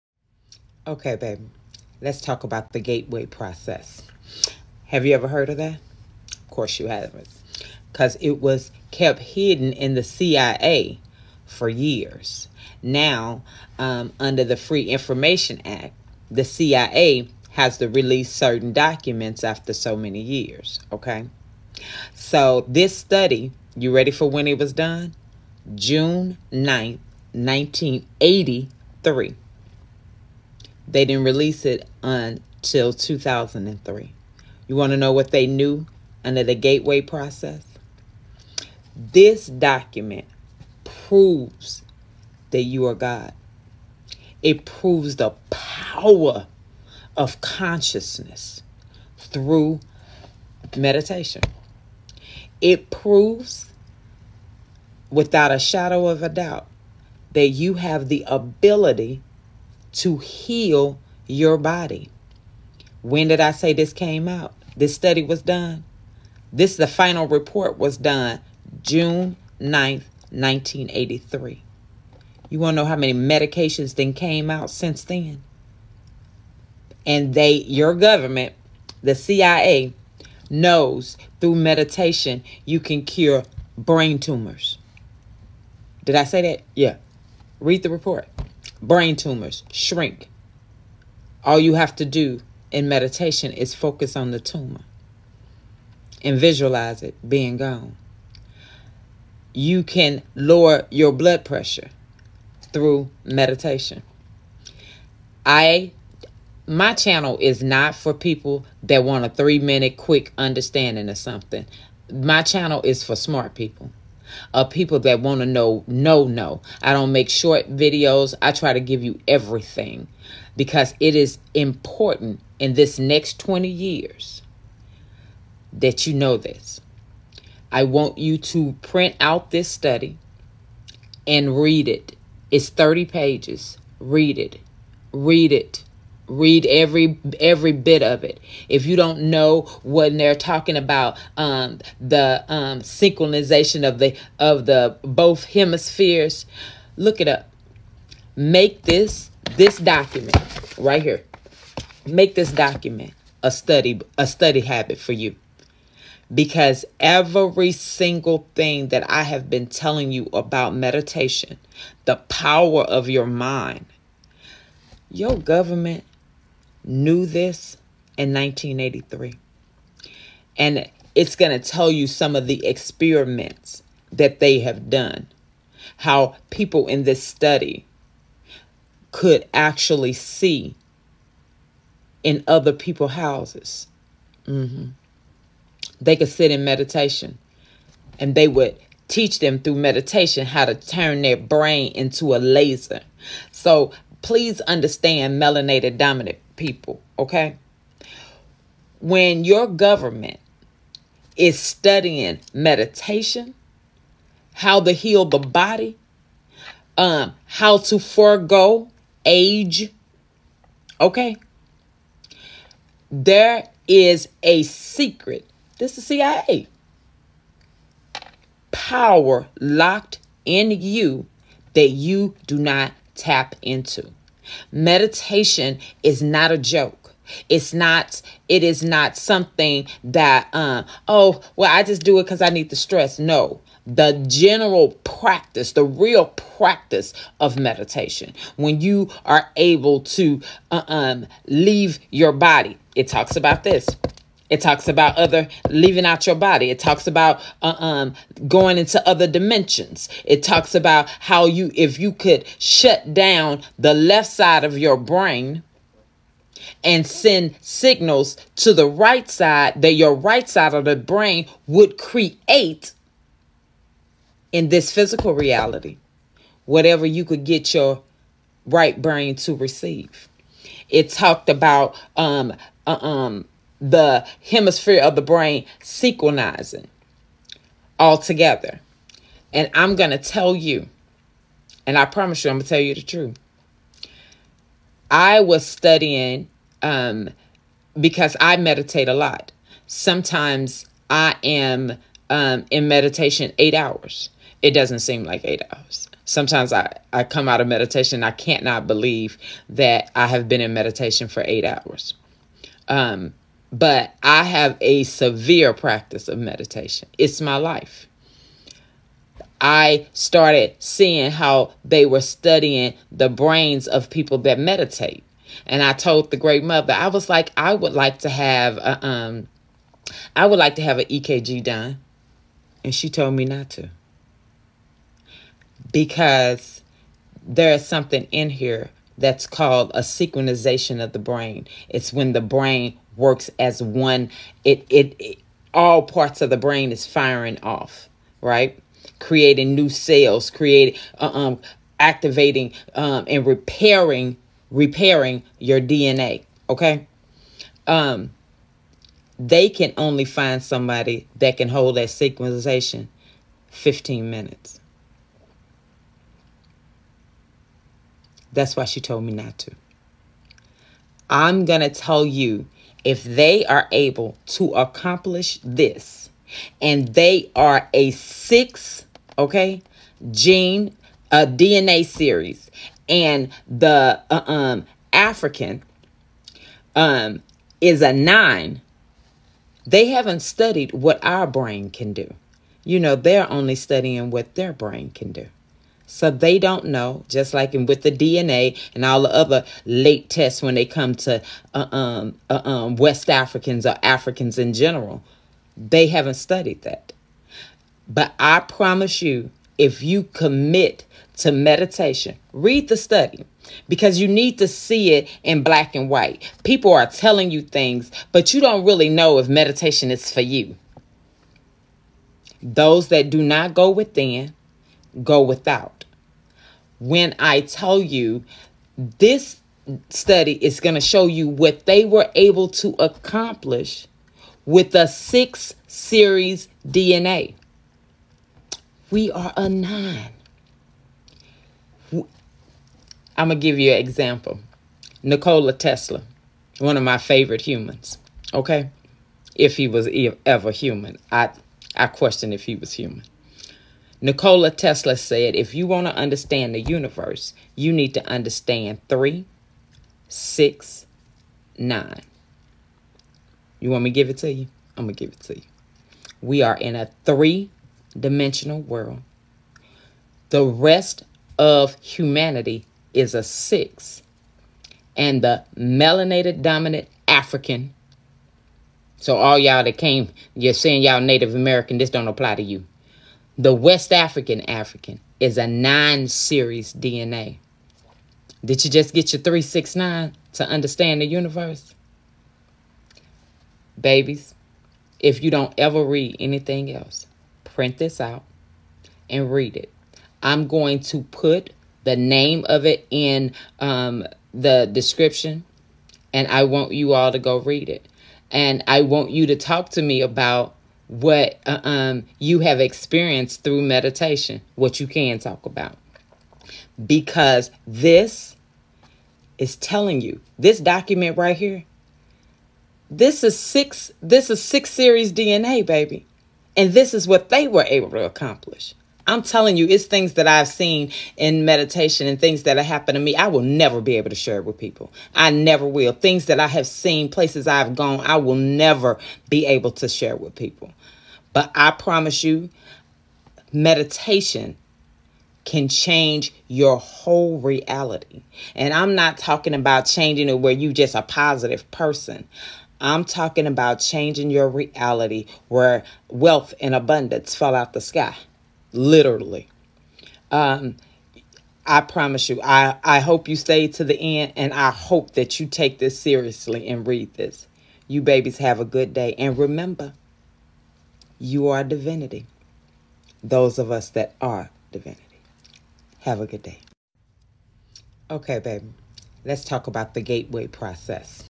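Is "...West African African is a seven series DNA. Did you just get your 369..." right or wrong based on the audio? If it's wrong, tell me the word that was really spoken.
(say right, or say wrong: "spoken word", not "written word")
wrong: "nine", not "seven".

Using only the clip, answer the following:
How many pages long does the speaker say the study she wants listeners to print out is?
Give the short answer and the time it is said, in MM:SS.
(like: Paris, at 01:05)
30, at 02:12.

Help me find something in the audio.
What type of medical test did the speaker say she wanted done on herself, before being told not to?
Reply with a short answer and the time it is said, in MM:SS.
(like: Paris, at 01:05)
EKG, at 05:21.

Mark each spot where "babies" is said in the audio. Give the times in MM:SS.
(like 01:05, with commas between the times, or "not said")
08:03, 09:18.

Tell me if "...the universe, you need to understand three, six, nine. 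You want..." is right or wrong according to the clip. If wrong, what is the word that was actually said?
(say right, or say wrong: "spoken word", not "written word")
right.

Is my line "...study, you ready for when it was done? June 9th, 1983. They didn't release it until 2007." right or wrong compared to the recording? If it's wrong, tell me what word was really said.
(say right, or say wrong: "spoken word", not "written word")
wrong: "2003", not "2007".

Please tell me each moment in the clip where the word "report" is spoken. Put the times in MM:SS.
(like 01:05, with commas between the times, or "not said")
01:07, 01:27.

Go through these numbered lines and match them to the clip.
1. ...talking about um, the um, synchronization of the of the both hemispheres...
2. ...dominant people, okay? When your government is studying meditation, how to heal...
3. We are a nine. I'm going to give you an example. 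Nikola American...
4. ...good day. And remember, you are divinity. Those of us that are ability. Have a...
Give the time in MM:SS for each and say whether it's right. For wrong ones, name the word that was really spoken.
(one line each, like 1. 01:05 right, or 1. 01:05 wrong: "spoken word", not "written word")
1. 02:20 right
2. 03:15 right
3. 07:09 wrong: "Tesla", not "American"
4. 09:18 wrong: "divinity", not "ability".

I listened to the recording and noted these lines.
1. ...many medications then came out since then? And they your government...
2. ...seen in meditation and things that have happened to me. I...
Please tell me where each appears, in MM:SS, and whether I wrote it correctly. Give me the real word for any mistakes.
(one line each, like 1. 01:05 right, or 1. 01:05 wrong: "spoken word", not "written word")
1. 01:12 right
2. 08:40 right.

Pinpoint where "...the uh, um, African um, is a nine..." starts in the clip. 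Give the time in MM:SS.
06:13.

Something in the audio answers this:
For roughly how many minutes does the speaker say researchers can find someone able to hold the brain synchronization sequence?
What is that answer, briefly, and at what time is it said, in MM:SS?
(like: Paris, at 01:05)
15, at 05:53.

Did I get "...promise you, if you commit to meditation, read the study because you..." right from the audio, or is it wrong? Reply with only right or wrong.
right.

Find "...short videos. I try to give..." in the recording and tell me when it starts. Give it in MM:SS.
01:57.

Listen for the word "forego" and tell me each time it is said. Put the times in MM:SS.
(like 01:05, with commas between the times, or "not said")
03:27.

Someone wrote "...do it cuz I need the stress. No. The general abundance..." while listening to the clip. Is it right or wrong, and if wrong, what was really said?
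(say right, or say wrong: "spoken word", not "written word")
wrong: "practice", not "abundance".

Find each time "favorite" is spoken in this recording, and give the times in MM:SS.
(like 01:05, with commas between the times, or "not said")
07:17.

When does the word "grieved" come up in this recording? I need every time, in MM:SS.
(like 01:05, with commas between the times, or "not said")
not said.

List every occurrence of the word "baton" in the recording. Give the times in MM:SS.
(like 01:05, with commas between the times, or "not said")
not said.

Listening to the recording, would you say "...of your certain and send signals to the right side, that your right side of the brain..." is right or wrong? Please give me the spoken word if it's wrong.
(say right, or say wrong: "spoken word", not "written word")
wrong: "brain", not "certain".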